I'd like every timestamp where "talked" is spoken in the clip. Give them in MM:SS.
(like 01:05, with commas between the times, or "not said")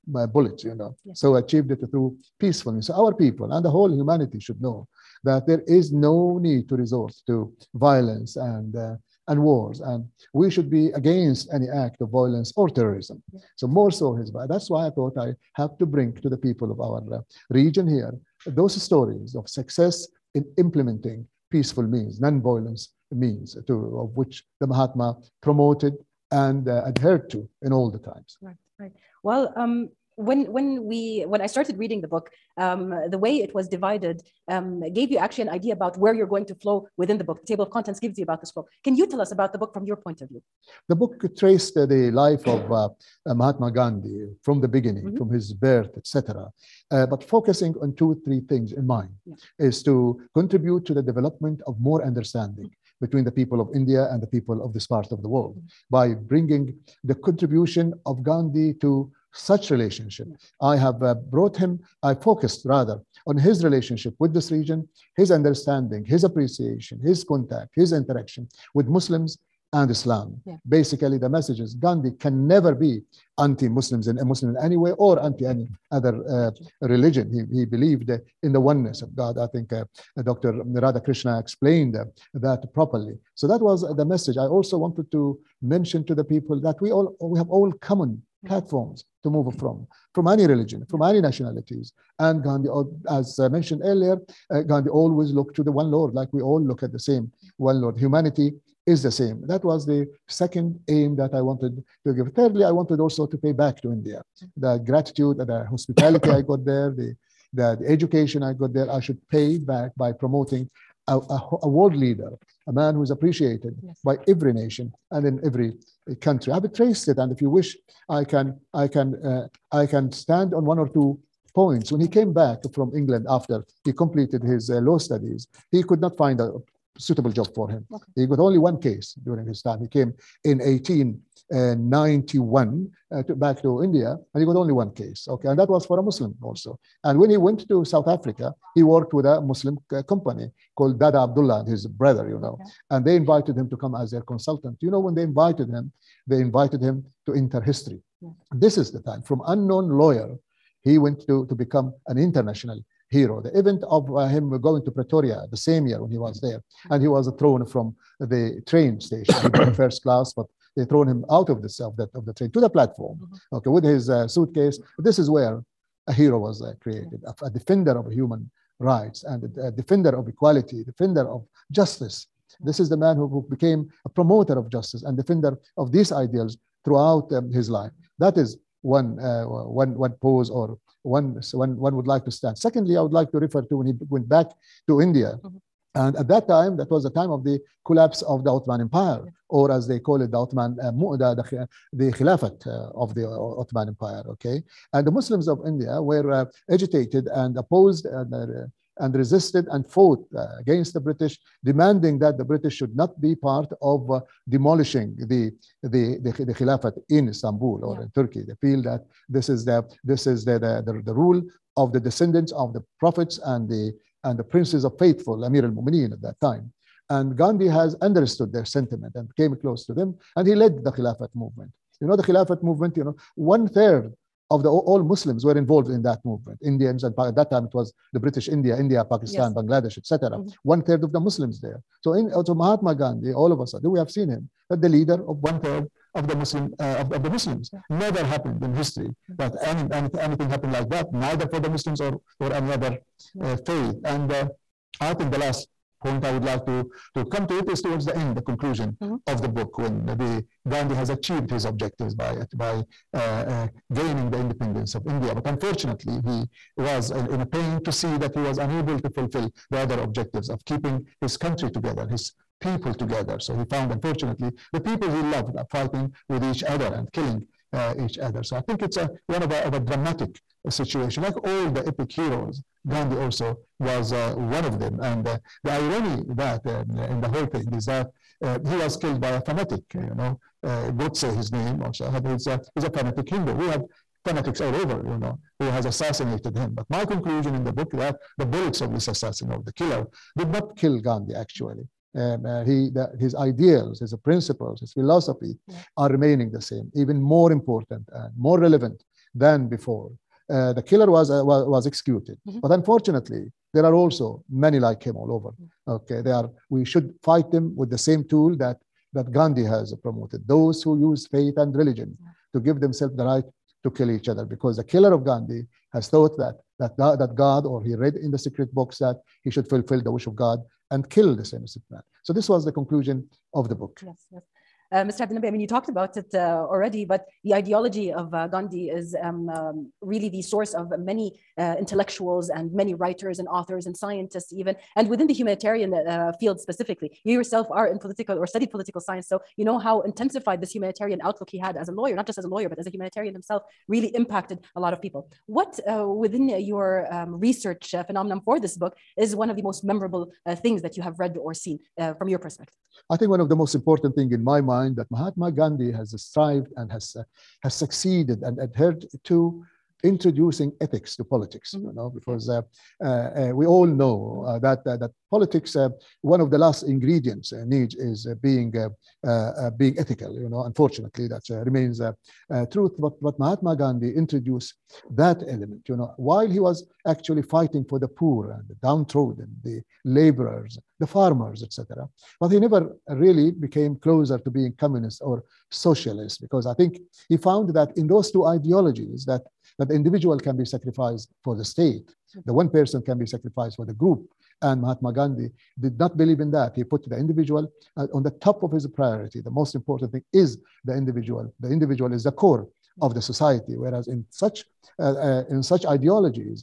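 05:25.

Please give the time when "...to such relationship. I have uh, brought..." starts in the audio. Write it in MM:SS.
00:58.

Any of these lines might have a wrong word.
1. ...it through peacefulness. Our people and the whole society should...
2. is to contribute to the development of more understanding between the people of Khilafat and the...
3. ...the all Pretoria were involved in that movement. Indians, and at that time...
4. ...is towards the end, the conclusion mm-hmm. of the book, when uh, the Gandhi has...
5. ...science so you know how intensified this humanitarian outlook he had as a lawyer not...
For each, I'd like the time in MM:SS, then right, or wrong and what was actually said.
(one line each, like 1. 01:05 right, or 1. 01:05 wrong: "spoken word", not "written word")
1. 00:01 wrong: "humanity", not "society"
2. 00:49 wrong: "India", not "Khilafat"
3. 03:44 wrong: "Muslims", not "Pretoria"
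4. 04:07 right
5. 05:39 right.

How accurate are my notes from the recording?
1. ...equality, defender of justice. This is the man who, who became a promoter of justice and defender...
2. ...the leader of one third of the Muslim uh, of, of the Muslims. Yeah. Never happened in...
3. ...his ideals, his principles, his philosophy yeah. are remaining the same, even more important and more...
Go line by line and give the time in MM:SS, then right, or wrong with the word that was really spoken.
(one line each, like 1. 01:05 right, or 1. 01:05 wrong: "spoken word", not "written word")
1. 02:50 right
2. 03:54 right
3. 04:53 right.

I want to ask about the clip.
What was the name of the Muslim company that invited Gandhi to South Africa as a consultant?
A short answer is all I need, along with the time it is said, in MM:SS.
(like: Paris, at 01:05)
Dada Abdullah, at 02:20.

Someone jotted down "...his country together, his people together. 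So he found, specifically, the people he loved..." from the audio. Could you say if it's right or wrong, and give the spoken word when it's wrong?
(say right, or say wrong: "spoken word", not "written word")
wrong: "unfortunately", not "specifically".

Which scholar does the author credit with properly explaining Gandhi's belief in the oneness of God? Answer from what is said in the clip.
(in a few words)
Dr. Radha Krishna.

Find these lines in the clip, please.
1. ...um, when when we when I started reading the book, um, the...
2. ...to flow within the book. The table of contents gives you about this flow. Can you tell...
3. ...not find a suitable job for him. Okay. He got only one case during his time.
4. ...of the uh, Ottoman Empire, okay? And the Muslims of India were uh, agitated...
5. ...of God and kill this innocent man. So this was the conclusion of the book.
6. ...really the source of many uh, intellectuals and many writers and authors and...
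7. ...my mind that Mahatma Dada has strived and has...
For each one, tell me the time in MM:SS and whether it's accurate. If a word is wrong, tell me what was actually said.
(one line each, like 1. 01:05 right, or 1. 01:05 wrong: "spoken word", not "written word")
1. 00:29 right
2. 00:36 right
3. 02:05 right
4. 03:12 right
5. 05:20 right
6. 05:30 right
7. 05:54 wrong: "Gandhi", not "Dada".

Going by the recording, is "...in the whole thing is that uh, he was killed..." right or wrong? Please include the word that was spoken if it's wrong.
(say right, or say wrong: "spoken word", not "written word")
right.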